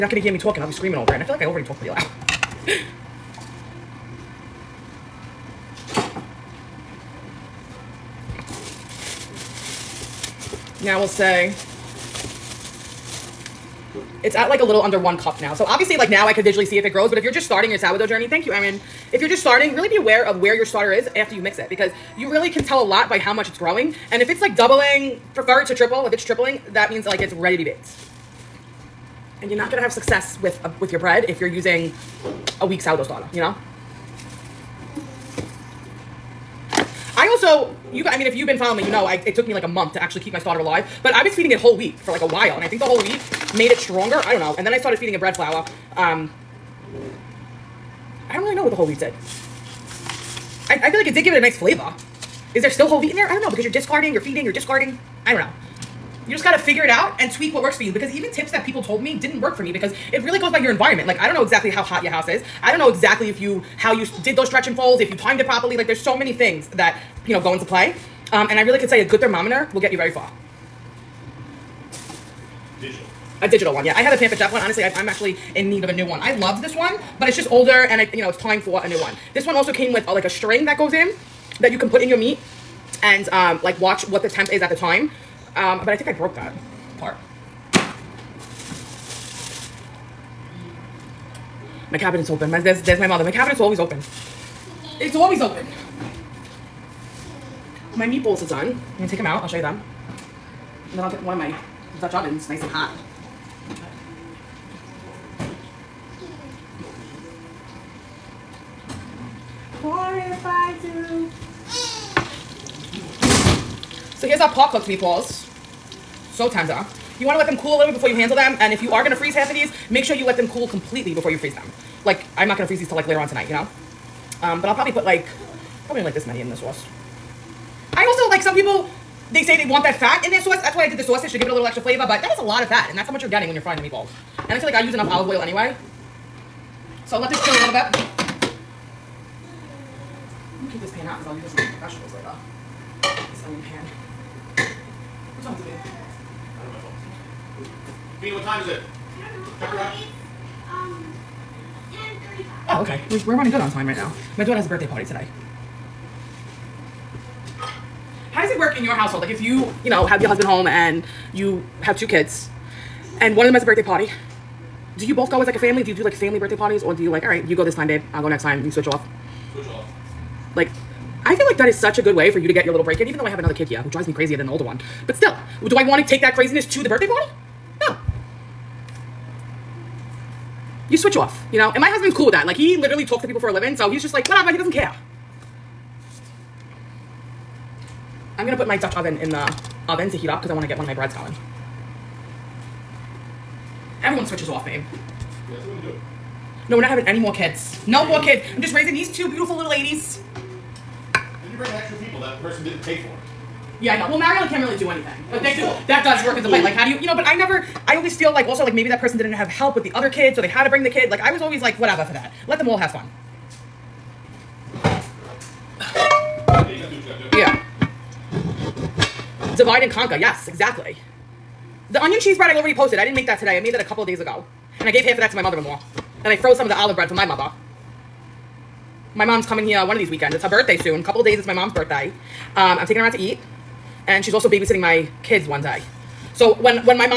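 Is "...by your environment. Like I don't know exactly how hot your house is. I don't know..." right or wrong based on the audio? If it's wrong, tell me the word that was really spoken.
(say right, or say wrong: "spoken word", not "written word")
right.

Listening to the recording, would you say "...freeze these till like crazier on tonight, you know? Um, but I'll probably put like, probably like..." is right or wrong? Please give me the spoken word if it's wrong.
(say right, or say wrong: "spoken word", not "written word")
wrong: "later", not "crazier".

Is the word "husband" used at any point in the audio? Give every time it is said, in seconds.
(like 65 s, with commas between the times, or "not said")
160 s, 181 s.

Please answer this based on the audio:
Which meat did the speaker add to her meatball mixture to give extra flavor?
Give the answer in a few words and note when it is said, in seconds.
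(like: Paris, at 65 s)
sausage, at 131 s.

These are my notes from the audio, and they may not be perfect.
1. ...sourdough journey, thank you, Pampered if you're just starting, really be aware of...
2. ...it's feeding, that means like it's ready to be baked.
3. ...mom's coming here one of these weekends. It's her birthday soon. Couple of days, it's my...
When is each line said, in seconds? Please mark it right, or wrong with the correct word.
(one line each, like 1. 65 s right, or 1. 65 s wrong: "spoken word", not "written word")
1. 17 s wrong: "Erin", not "Pampered"
2. 26 s wrong: "tripling", not "feeding"
3. 229 s right.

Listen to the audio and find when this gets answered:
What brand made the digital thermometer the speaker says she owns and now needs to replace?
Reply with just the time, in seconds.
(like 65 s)
74 s.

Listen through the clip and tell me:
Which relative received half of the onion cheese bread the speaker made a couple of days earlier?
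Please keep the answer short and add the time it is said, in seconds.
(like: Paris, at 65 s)
mother-in-law, at 225 s.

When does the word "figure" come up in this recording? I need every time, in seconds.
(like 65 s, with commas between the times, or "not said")
56 s.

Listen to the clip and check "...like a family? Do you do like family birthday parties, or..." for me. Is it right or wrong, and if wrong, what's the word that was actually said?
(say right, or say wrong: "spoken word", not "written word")
right.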